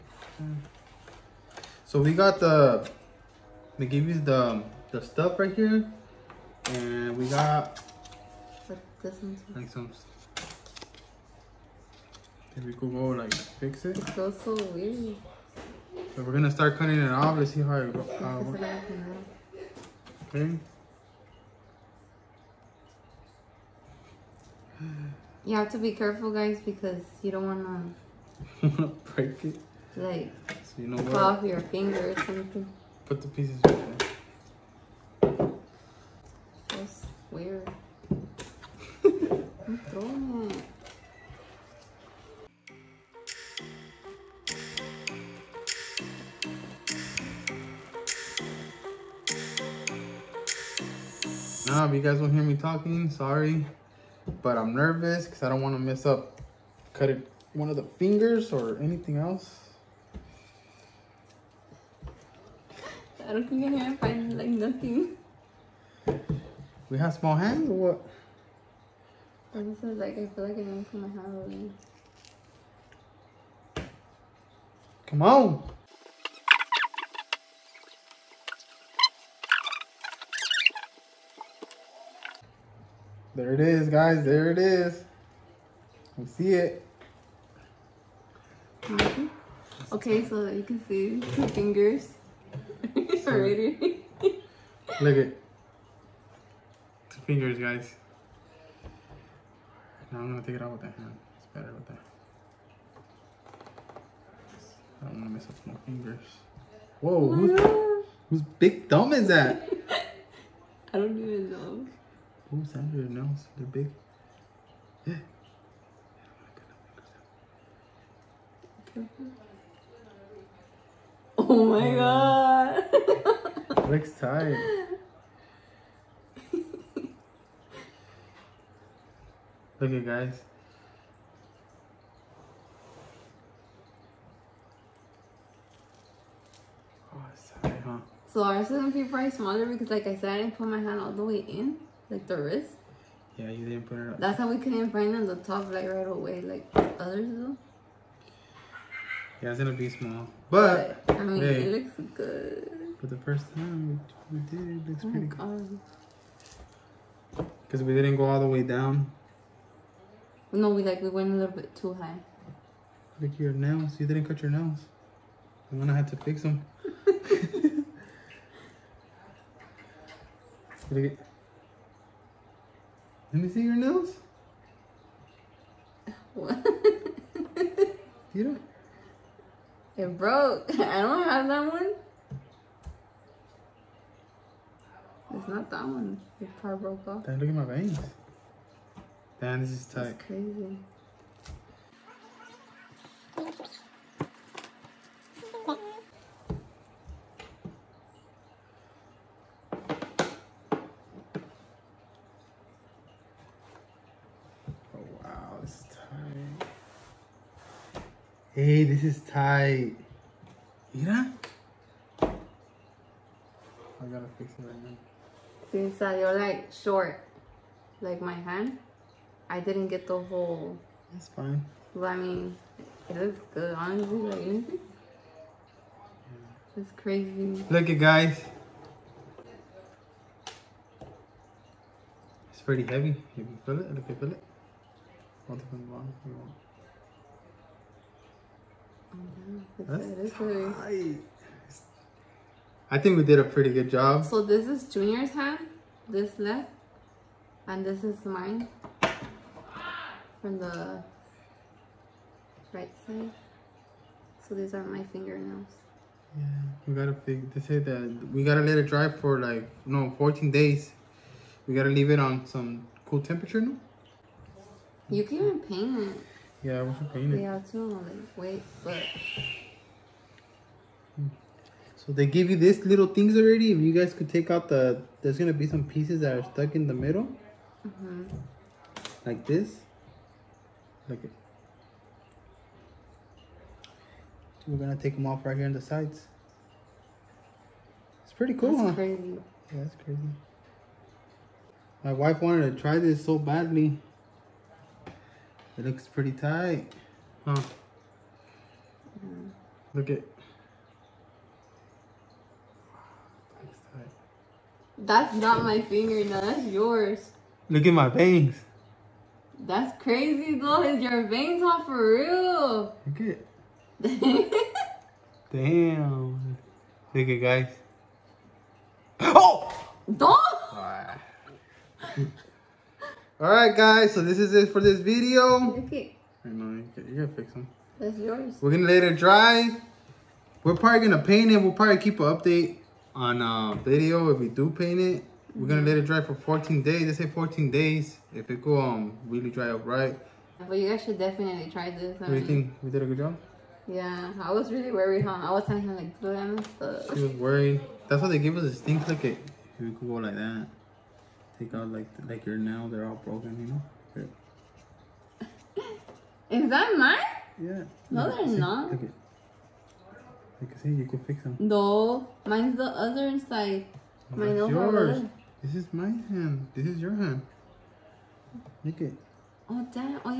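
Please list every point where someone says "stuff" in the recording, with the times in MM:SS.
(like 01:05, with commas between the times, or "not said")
00:05, 05:46.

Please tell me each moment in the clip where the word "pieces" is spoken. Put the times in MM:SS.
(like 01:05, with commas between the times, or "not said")
00:33, 04:35.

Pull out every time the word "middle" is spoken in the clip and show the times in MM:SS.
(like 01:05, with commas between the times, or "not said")
04:36.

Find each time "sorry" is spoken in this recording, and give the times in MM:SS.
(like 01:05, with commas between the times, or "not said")
00:53, 02:17.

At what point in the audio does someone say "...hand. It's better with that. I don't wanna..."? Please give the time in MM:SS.
01:40.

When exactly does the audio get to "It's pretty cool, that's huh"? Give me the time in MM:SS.
04:48.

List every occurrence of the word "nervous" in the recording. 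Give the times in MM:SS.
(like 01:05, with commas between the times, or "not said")
00:54.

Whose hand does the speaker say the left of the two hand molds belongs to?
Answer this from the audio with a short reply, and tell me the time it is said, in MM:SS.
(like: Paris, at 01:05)
Junior, at 04:04.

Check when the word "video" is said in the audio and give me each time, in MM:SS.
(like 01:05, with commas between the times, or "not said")
05:25, 05:33.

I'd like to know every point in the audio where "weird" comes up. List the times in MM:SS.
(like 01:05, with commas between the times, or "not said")
00:14, 00:37.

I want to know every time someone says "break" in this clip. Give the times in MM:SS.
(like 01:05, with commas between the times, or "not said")
00:29.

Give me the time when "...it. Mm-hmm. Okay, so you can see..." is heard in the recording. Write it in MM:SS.
01:26.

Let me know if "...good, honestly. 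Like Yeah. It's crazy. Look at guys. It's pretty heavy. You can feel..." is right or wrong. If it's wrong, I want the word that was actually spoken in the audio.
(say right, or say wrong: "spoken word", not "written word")
right.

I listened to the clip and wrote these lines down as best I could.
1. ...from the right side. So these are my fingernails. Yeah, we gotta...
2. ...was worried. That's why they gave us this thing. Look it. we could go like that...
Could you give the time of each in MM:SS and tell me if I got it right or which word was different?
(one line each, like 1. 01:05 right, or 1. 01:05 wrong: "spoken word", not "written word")
1. 04:10 right
2. 05:47 right.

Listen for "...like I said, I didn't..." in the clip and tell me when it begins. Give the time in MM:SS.
02:19.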